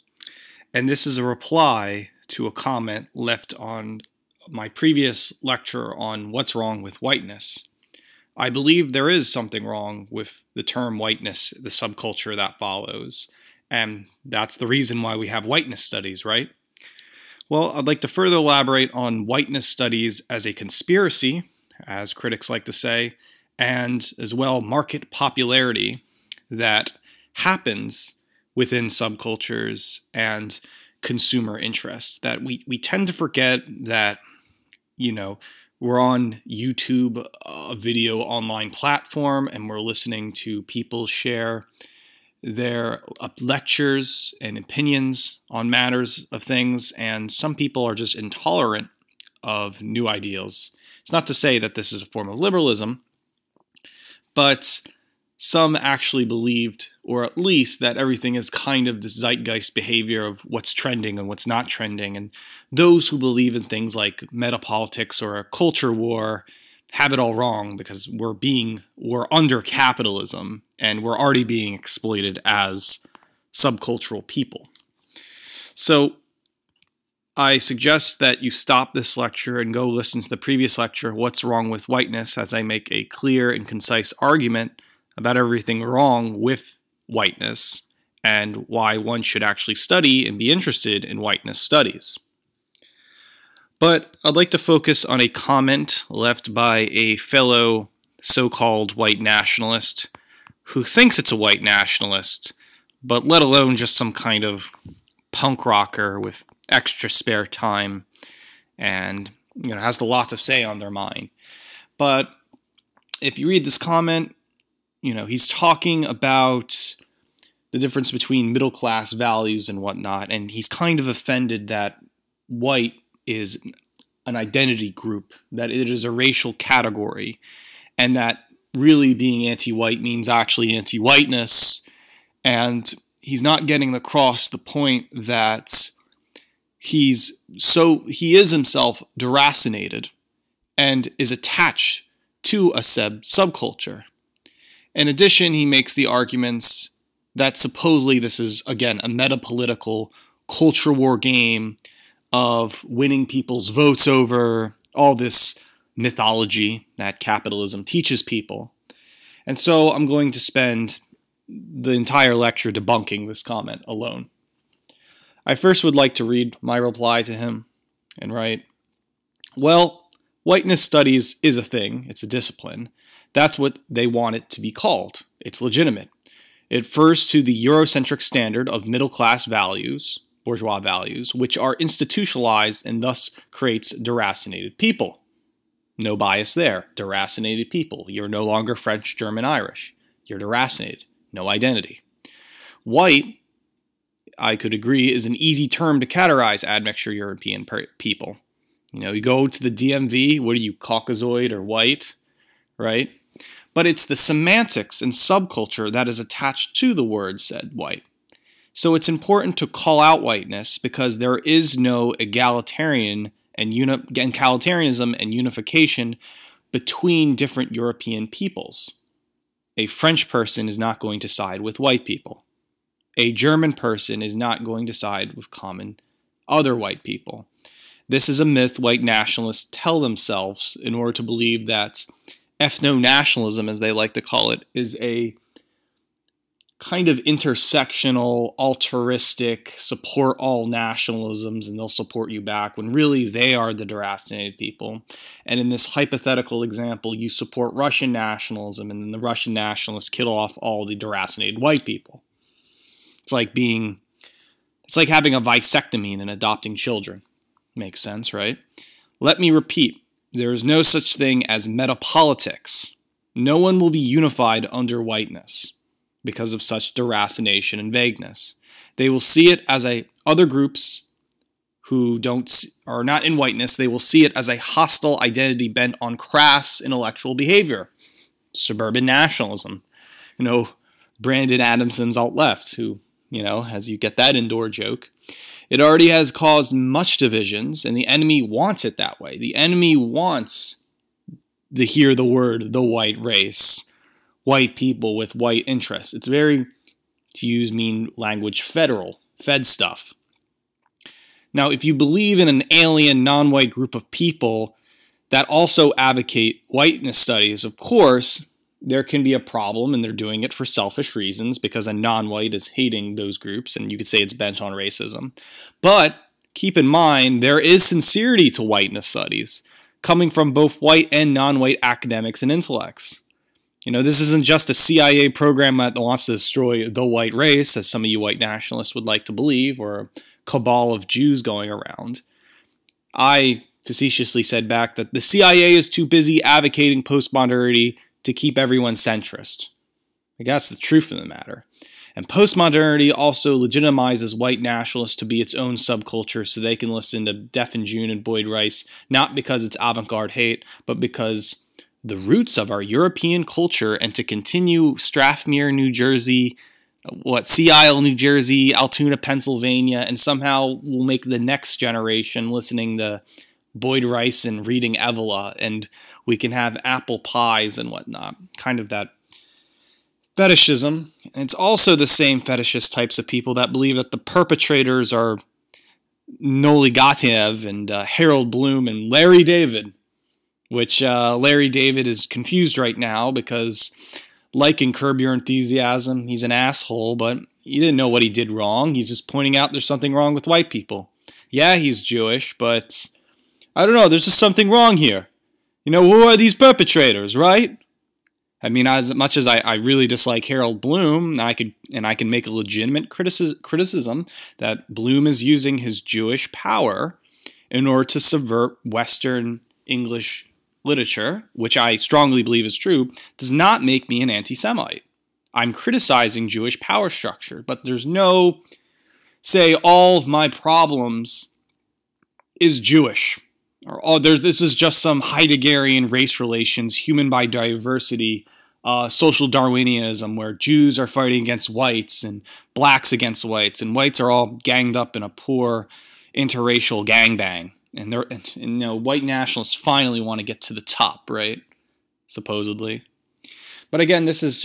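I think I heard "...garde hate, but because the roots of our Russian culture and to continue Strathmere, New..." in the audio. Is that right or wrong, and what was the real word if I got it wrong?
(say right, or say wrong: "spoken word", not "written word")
wrong: "European", not "Russian".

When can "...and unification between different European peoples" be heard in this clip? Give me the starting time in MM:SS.
03:35.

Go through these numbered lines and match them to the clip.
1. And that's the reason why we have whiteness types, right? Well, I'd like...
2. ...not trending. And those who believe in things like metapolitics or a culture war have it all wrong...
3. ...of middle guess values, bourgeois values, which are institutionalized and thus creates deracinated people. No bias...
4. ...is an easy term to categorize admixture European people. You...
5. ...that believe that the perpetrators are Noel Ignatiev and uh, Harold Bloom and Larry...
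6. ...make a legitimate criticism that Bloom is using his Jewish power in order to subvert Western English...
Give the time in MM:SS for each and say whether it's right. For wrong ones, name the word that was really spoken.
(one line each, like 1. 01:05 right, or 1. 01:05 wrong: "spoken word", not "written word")
1. 00:13 wrong: "studies", not "types"
2. 01:01 right
3. 02:58 wrong: "class", not "guess"
4. 03:15 right
5. 06:13 right
6. 06:42 right.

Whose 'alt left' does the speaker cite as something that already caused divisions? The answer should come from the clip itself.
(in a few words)
Brandon Adamson.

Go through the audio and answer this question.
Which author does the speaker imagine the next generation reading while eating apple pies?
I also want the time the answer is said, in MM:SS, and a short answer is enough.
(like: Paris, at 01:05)
Evola, at 06:04.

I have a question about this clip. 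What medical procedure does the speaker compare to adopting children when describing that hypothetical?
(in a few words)
vasectomy.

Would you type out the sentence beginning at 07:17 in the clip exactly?
And they're, and, you know, white nationalists finally want to get to the top, right?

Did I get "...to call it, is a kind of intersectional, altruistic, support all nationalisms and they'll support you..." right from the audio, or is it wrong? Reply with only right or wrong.
right.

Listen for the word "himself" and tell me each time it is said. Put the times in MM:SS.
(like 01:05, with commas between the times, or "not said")
02:18.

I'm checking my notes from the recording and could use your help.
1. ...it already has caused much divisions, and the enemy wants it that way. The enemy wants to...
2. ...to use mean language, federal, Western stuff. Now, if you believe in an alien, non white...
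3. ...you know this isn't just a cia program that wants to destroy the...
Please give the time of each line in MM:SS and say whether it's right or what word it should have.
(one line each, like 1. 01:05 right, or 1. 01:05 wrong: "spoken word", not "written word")
1. 04:45 right
2. 04:57 wrong: "Fed", not "Western"
3. 05:23 right.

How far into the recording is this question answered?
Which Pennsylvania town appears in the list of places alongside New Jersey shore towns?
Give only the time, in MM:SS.
05:58.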